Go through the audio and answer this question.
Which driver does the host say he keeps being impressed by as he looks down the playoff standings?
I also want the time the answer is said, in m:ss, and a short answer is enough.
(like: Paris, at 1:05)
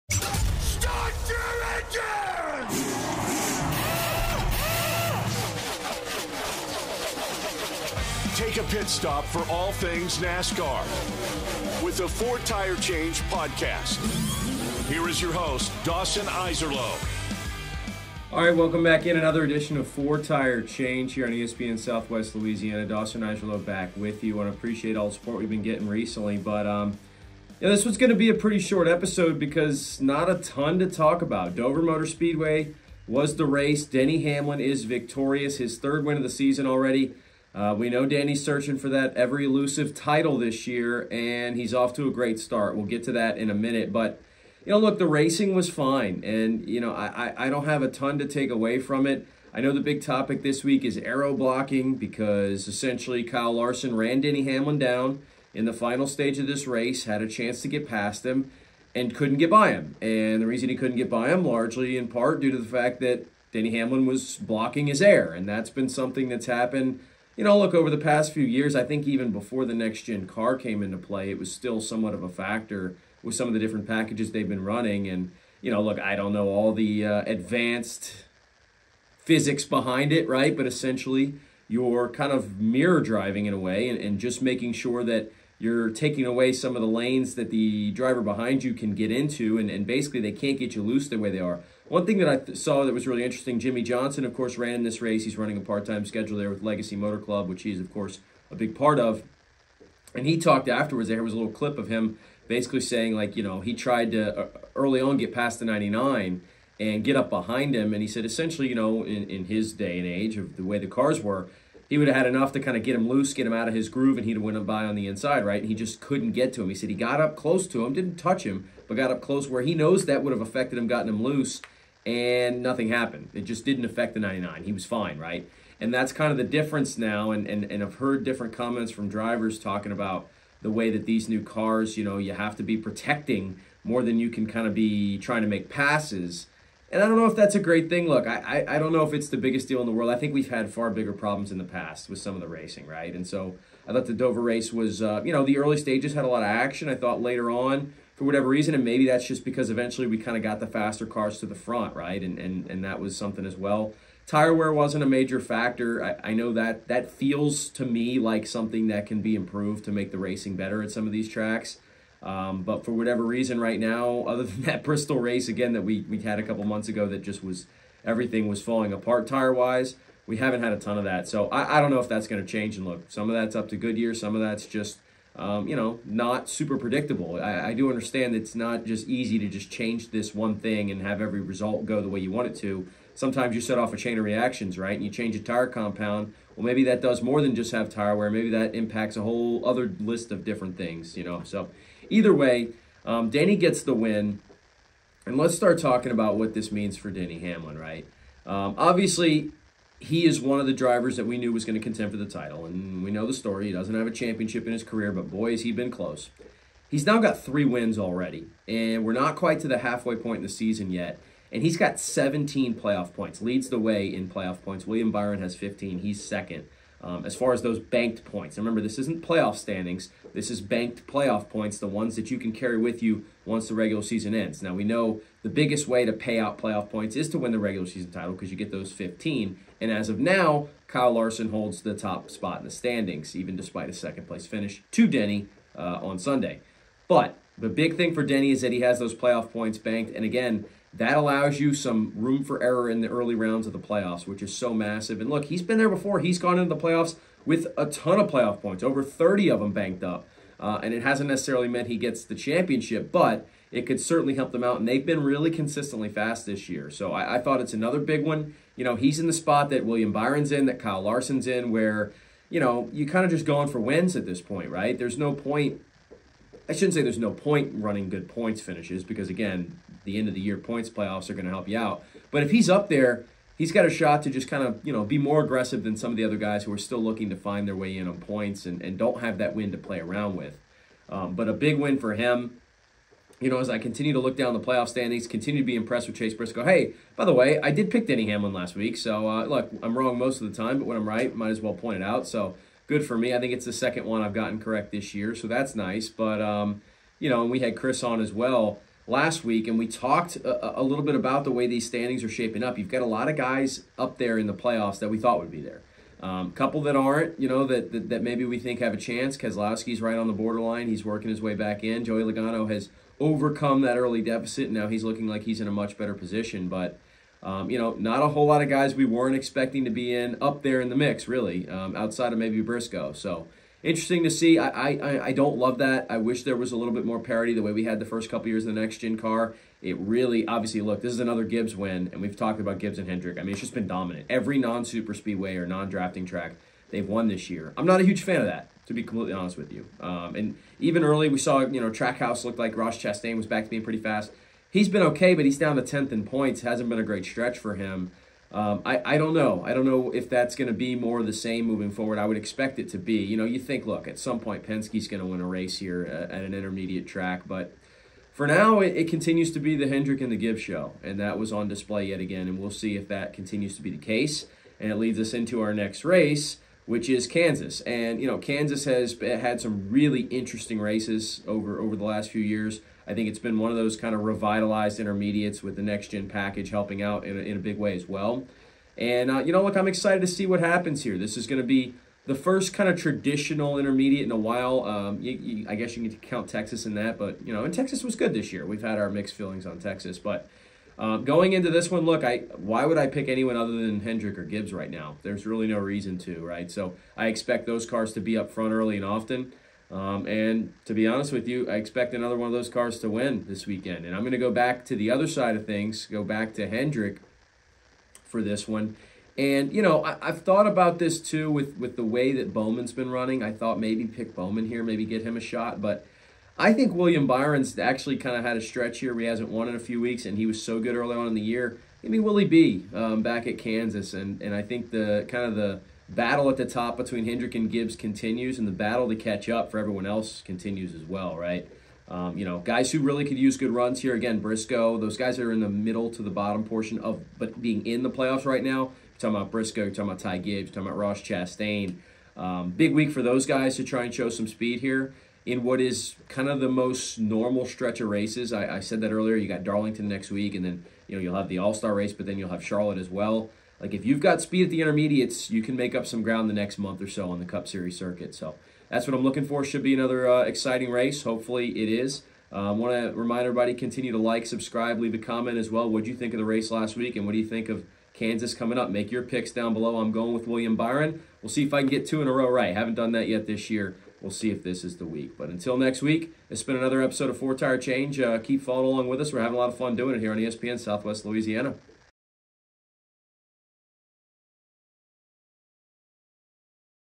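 Chase Briscoe, at 4:46.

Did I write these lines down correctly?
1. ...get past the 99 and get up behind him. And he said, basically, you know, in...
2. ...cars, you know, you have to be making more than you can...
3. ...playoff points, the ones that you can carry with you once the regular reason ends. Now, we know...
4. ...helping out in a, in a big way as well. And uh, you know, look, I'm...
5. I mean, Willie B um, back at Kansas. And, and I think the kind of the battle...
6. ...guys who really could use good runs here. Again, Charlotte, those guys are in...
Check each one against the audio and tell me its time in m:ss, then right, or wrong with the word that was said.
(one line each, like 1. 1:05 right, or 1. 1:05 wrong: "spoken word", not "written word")
1. 1:45 wrong: "essentially", not "basically"
2. 2:11 wrong: "protecting", not "making"
3. 3:41 wrong: "season", not "reason"
4. 6:16 right
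5. 7:02 right
6. 7:12 wrong: "Briscoe", not "Charlotte".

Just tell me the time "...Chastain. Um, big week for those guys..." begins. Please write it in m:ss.
7:21.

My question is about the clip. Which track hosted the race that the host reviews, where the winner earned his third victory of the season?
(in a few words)
Dover Motor Speedway.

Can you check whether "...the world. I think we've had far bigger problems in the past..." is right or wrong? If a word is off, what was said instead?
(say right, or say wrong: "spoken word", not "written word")
right.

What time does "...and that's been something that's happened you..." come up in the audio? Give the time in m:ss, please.
1:05.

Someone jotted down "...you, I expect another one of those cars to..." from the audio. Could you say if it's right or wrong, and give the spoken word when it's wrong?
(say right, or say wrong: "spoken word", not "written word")
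right.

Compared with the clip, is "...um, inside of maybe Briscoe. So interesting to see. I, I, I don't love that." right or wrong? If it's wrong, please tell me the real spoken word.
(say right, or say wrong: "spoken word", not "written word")
wrong: "outside", not "inside".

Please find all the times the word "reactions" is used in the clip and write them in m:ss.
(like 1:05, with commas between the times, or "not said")
3:04.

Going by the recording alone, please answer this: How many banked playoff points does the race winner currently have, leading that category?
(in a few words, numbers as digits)
17.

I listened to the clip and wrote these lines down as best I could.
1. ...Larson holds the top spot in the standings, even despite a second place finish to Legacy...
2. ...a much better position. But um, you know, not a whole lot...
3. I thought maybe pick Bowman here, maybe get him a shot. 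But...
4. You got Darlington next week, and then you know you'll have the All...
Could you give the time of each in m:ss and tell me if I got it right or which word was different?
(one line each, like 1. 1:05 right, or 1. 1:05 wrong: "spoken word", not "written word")
1. 3:51 wrong: "Denny", not "Legacy"
2. 5:15 right
3. 6:53 right
4. 7:29 right.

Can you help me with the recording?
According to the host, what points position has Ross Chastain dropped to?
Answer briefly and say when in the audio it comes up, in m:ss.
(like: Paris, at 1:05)
10th, at 5:45.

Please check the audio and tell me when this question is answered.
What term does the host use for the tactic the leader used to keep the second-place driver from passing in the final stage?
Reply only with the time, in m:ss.
0:50.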